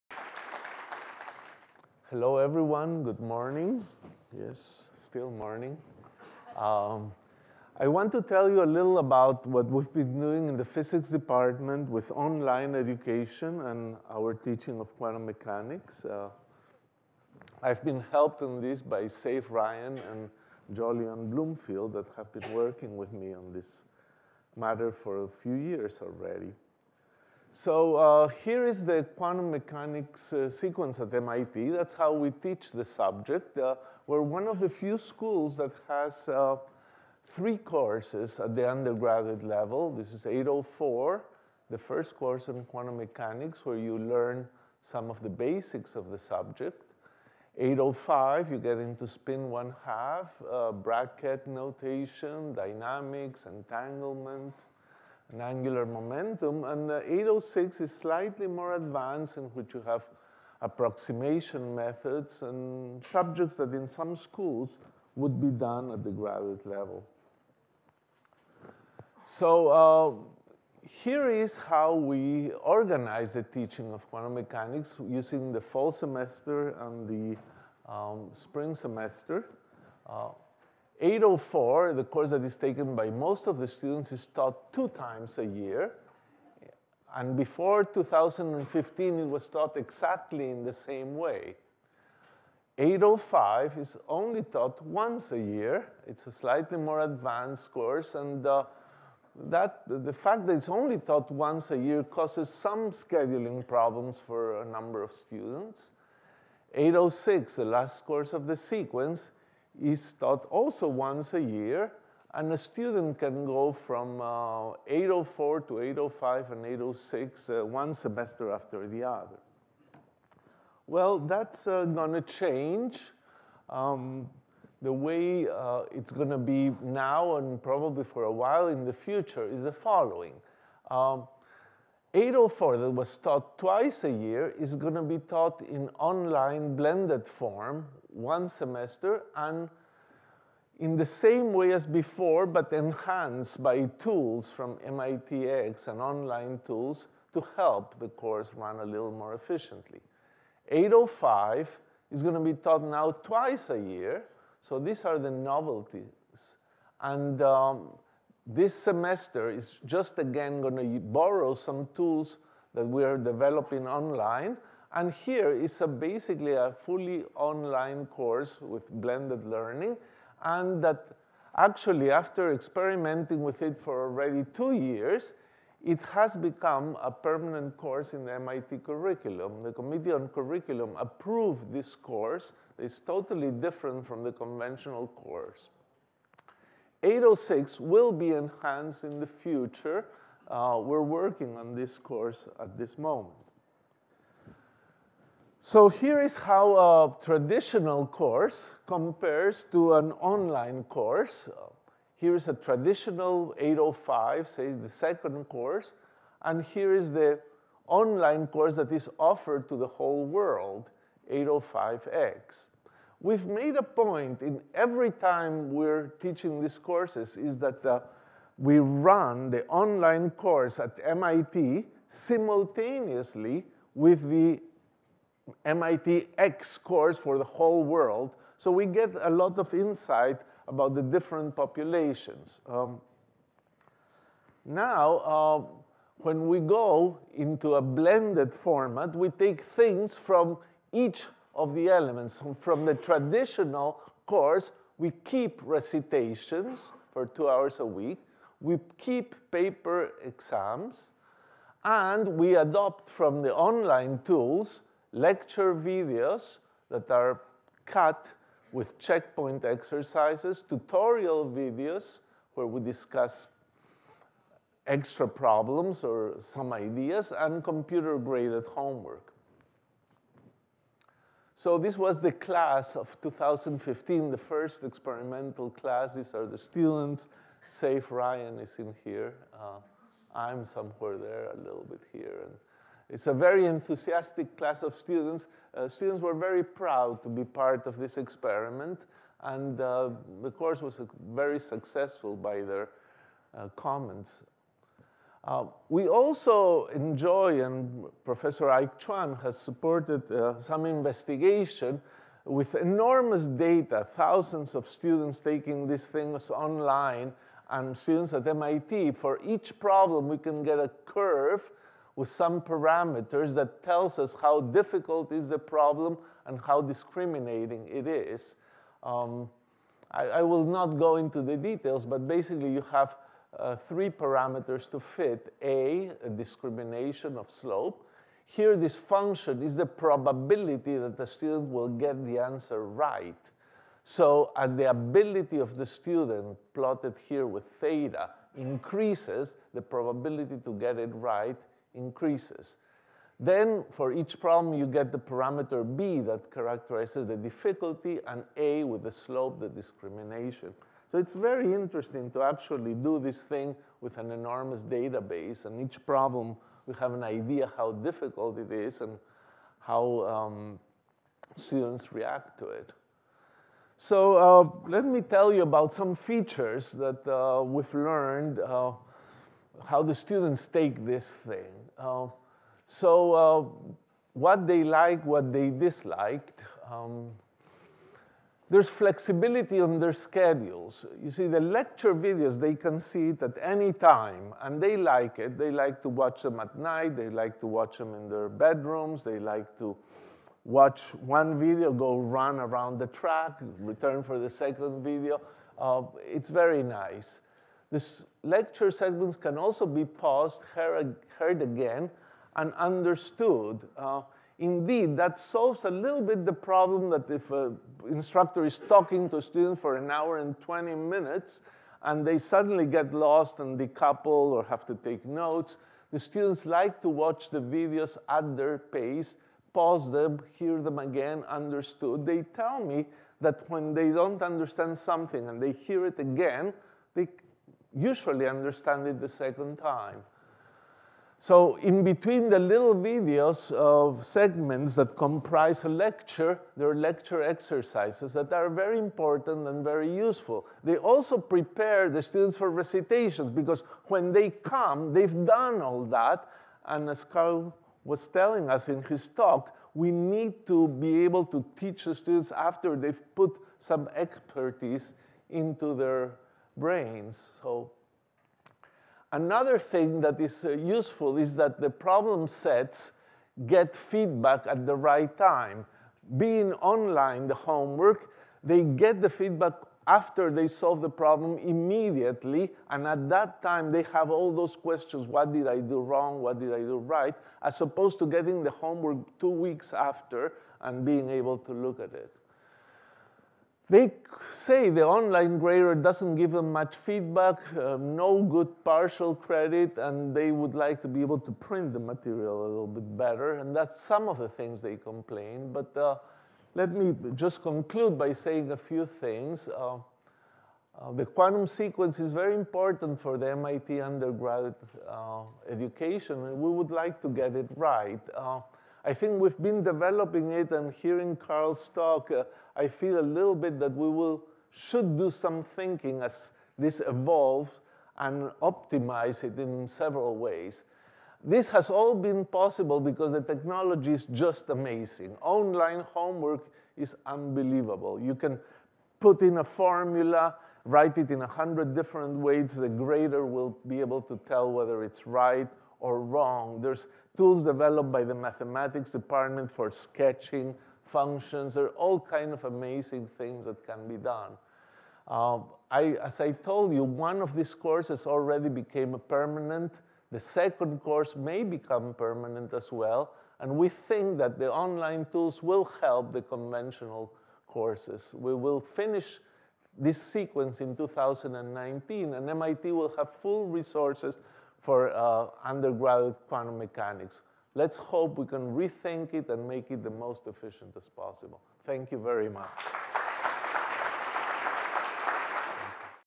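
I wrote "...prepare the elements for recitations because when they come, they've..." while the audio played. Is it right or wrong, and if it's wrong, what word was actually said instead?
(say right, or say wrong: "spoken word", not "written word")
wrong: "students", not "elements".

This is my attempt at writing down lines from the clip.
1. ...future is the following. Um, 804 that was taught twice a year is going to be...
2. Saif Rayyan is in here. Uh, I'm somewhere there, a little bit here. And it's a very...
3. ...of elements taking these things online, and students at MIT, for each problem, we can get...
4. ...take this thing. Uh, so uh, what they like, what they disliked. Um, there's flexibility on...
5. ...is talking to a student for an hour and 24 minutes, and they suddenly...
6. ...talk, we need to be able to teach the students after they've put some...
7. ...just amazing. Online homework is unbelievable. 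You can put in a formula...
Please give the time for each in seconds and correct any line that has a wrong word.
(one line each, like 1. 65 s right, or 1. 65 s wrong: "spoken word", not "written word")
1. 128 s right
2. 277 s right
3. 304 s wrong: "students", not "elements"
4. 370 s right
5. 408 s wrong: "20", not "24"
6. 449 s right
7. 524 s right.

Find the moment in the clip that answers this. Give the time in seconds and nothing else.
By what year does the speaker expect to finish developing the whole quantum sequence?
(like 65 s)
560 s.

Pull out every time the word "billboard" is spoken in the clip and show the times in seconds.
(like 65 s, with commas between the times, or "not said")
not said.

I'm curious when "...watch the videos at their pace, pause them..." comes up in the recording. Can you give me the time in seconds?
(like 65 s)
417 s.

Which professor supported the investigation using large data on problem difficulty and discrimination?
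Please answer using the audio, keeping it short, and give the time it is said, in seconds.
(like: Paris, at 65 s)
Ike Chuang, at 298 s.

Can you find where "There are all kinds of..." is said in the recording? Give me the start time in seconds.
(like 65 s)
541 s.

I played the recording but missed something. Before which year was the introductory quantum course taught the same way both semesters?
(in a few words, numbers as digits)
2015.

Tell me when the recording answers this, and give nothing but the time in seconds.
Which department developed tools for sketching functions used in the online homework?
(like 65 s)
538 s.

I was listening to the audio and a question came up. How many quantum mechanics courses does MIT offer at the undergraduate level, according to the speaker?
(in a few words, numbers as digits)
3.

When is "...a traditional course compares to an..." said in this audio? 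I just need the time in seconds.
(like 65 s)
196 s.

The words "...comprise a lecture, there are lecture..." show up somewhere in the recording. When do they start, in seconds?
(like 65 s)
435 s.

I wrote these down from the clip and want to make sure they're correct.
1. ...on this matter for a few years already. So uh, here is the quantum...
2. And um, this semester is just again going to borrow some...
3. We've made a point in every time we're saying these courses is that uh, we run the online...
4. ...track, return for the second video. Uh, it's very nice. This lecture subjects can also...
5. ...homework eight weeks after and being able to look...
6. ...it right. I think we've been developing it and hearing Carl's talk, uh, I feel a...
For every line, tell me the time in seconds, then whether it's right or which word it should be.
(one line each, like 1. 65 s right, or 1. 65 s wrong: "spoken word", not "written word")
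1. 23 s right
2. 157 s right
3. 213 s wrong: "teaching", not "saying"
4. 393 s wrong: "segments", not "subjects"
5. 478 s wrong: "two", not "eight"
6. 507 s right.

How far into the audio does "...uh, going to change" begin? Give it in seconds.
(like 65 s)
121 s.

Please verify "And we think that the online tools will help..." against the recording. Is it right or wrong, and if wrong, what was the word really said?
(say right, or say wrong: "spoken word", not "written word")
right.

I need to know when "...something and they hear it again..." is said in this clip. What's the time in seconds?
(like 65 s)
424 s.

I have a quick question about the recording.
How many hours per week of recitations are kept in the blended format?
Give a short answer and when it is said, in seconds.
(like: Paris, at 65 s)
2, at 247 s.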